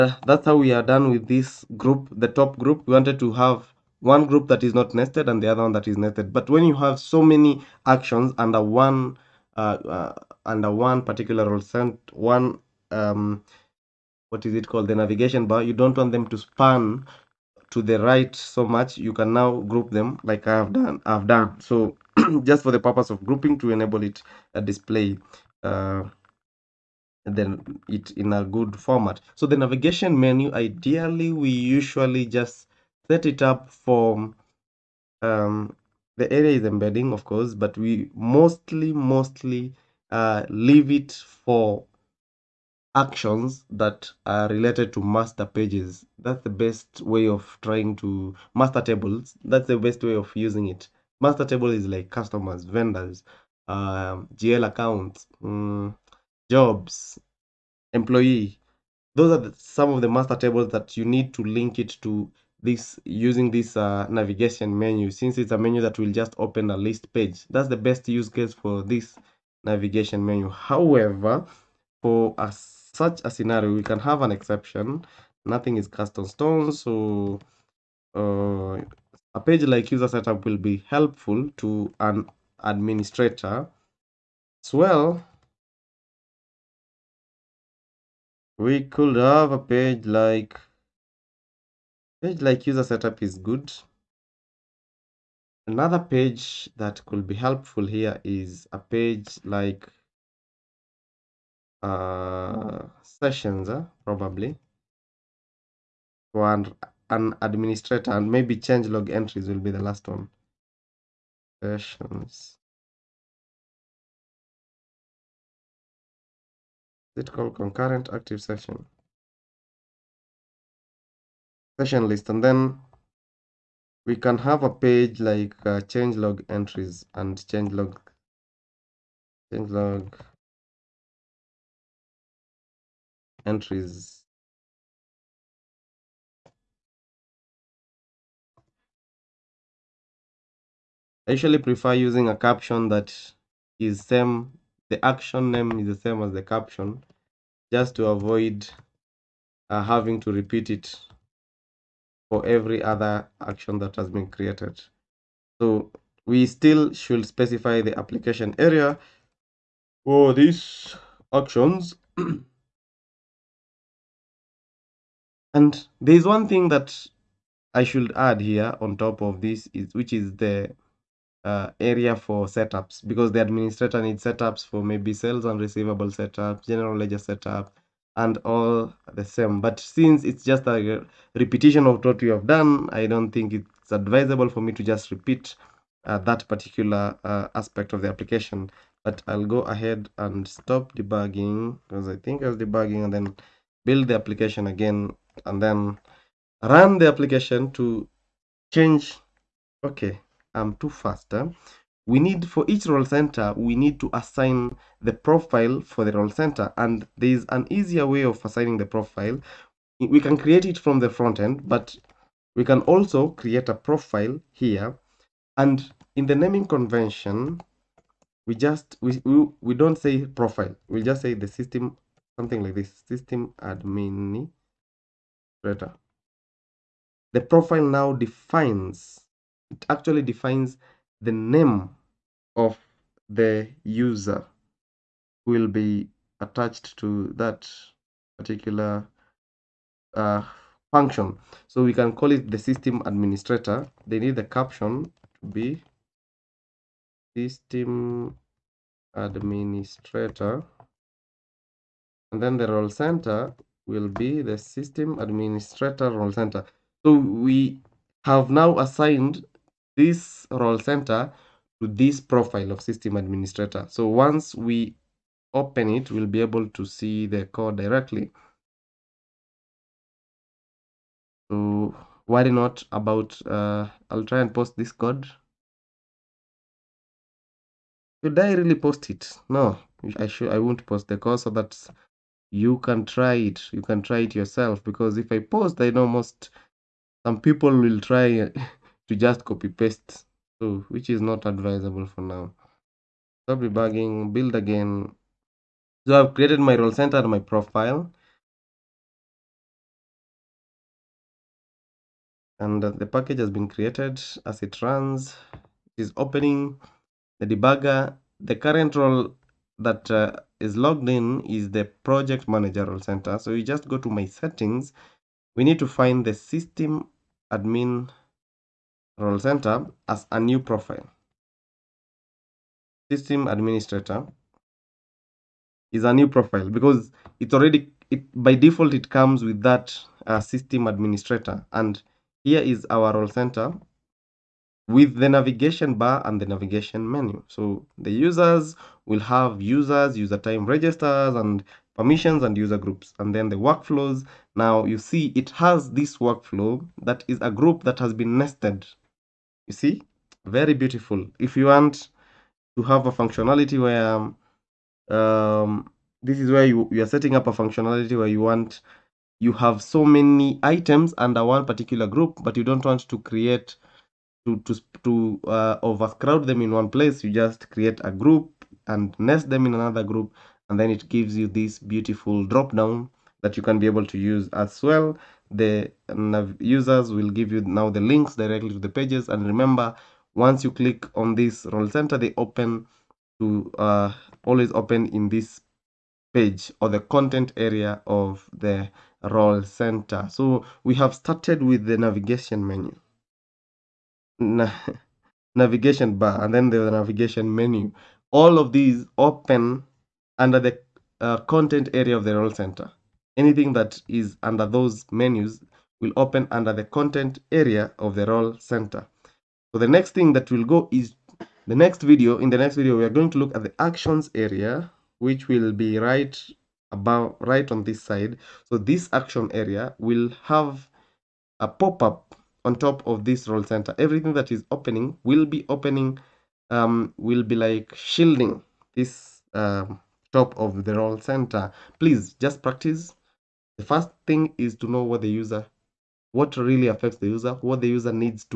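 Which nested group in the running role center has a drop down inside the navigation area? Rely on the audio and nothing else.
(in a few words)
Workflows.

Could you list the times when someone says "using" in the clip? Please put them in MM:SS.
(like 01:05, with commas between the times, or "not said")
00:50, 01:03, 02:21.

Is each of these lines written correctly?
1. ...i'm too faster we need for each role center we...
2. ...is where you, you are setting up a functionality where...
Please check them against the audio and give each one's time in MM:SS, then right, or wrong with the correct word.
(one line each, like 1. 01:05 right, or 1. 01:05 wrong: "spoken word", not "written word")
1. 03:20 right
2. 05:56 right.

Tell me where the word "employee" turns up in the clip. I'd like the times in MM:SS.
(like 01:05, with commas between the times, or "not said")
00:57.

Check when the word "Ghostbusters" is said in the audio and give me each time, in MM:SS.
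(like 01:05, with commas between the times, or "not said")
not said.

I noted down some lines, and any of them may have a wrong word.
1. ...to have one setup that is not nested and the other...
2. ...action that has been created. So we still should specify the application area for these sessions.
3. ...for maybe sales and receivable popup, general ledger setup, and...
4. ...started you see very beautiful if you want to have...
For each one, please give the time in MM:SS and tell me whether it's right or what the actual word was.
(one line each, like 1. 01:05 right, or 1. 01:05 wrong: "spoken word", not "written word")
1. 00:03 wrong: "group", not "setup"
2. 02:33 wrong: "actions", not "sessions"
3. 02:54 wrong: "setup", not "popup"
4. 05:48 wrong: "nested", not "started".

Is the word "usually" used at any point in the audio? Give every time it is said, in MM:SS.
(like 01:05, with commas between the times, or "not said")
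00:31, 02:21.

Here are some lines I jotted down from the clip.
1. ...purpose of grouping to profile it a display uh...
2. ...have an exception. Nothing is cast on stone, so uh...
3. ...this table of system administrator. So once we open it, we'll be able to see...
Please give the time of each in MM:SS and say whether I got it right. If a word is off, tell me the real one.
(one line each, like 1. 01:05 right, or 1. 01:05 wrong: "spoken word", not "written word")
1. 00:22 wrong: "enable", not "profile"
2. 01:13 right
3. 04:21 wrong: "profile", not "table".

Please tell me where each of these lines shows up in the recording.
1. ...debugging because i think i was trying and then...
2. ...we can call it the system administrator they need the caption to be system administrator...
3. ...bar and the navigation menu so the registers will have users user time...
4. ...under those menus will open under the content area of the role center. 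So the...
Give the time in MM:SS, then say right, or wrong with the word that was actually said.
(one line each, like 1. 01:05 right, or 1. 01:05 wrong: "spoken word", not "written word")
1. 03:10 wrong: "debugging", not "trying"
2. 04:01 right
3. 05:35 wrong: "users", not "registers"
4. 06:44 right.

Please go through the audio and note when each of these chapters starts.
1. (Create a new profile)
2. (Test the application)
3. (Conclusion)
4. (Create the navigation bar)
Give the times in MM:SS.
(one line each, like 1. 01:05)
1. 03:28
2. 04:53
3. 06:48
4. 00:28.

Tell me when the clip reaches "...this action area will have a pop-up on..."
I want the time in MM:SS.
06:58.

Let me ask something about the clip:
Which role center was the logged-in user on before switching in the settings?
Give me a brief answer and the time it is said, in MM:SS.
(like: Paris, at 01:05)
Project manager, at 05:12.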